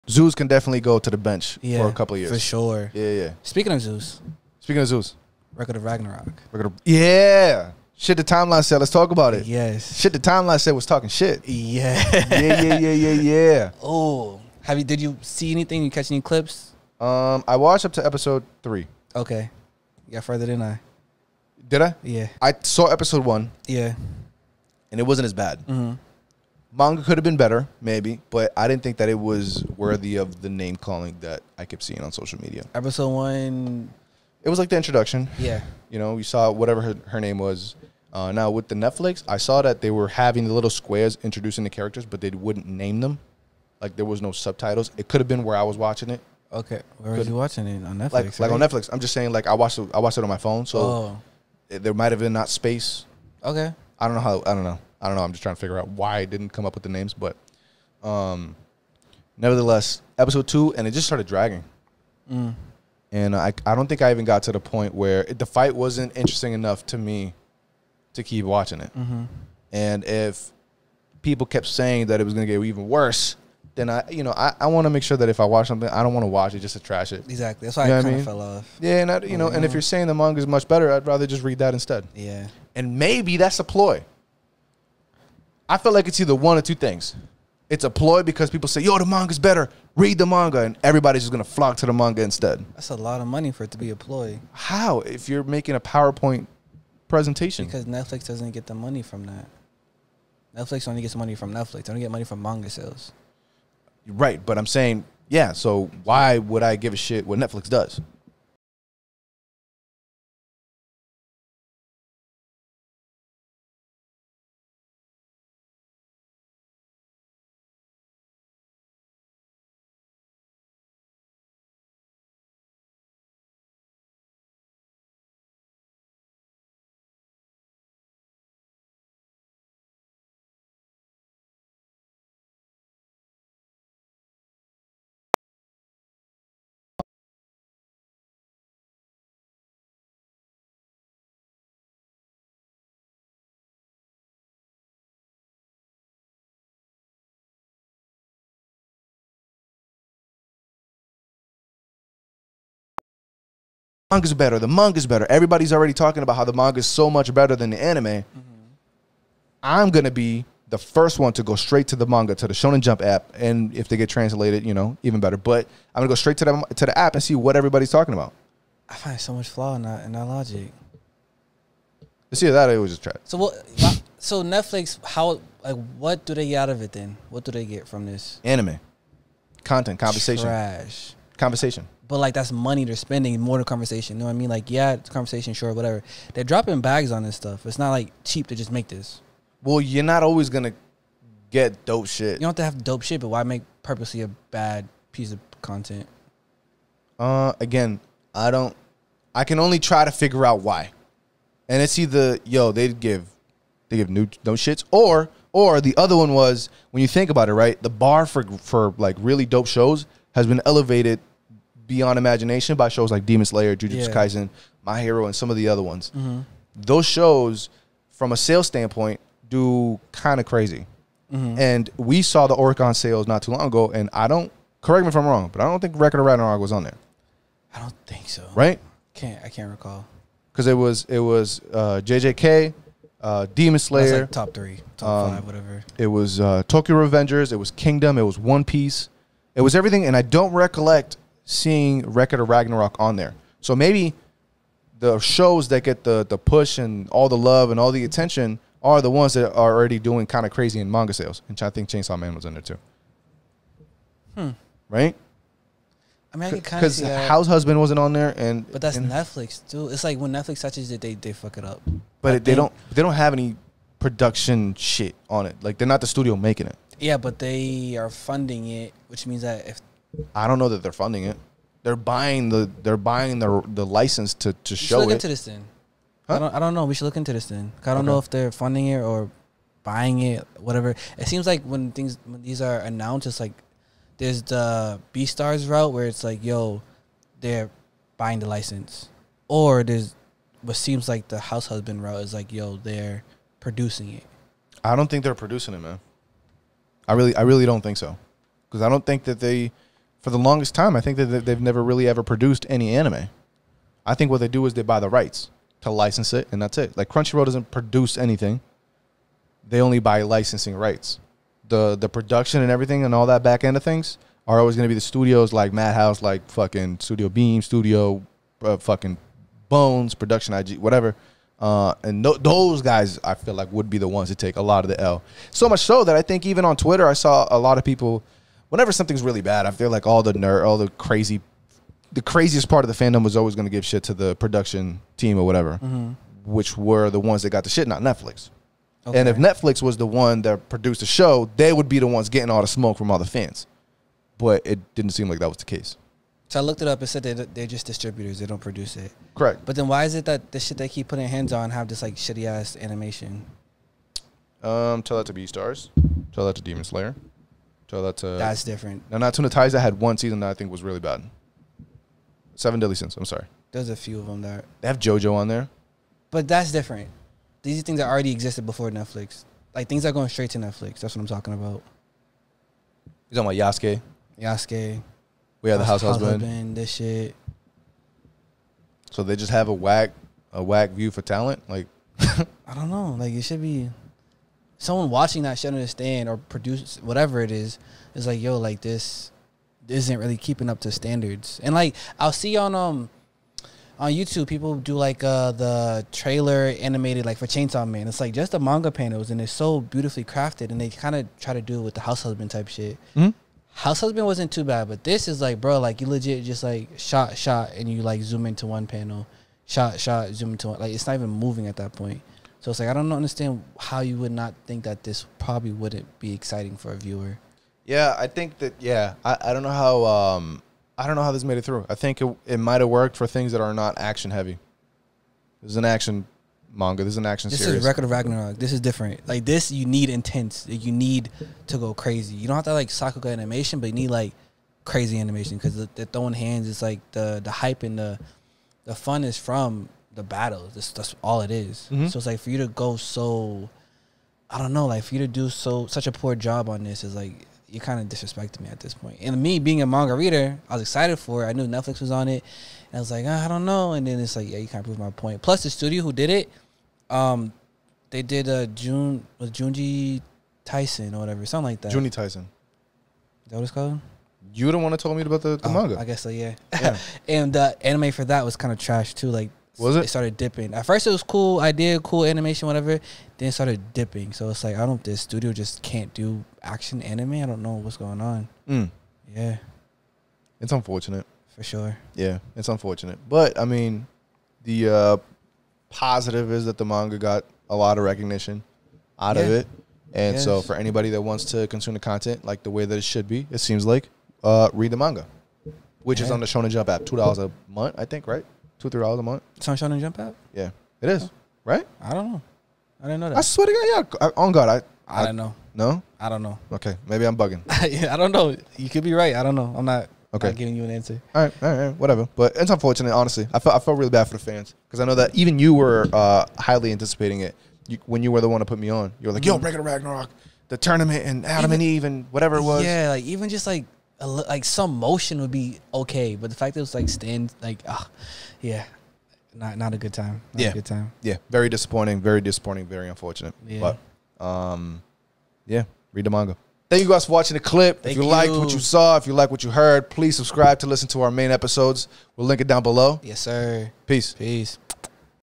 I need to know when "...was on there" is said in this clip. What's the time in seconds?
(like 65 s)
226 s.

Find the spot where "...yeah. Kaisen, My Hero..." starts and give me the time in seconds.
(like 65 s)
214 s.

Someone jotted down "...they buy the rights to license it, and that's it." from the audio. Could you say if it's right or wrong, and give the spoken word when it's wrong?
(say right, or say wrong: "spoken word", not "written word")
right.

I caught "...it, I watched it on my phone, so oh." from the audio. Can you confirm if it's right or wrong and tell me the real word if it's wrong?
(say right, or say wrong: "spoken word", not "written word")
right.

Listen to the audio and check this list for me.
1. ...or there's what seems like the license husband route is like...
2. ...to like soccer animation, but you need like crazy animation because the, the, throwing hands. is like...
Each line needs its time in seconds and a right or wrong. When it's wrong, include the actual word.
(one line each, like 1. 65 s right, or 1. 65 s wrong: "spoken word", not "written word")
1. 289 s wrong: "house", not "license"
2. 432 s right.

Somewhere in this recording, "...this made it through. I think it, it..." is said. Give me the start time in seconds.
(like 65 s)
421 s.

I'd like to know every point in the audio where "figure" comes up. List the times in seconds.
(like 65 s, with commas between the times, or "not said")
55 s, 200 s.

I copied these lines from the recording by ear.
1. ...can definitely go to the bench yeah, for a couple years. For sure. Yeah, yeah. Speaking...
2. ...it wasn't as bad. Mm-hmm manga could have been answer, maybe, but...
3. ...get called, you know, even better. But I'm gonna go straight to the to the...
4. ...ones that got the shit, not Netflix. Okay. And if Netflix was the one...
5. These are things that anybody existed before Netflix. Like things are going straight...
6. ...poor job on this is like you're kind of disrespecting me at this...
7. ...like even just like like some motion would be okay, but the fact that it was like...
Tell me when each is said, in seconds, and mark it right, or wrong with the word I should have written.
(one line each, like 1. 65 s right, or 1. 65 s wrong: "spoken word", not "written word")
1. 0 s right
2. 24 s wrong: "better", not "answer"
3. 163 s wrong: "translated", not "called"
4. 337 s right
5. 367 s wrong: "already", not "anybody"
6. 446 s right
7. 523 s right.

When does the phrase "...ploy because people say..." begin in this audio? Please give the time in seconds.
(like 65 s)
87 s.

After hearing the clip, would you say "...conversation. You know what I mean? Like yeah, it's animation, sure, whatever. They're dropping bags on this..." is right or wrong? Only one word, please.
wrong.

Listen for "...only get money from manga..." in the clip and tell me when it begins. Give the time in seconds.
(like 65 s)
101 s.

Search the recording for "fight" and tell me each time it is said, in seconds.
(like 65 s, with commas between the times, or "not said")
65 s.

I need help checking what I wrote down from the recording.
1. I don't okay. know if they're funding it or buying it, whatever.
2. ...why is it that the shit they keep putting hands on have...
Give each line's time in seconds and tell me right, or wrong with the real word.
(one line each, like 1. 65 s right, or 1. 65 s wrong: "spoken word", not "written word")
1. 277 s right
2. 349 s right.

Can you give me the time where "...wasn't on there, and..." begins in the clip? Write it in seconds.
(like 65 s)
257 s.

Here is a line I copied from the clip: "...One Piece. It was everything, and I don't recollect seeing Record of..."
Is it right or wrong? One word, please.
right.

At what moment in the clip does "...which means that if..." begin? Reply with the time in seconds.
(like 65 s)
269 s.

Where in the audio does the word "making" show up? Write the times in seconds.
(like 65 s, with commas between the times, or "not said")
95 s, 266 s.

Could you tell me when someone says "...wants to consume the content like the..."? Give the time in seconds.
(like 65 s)
491 s.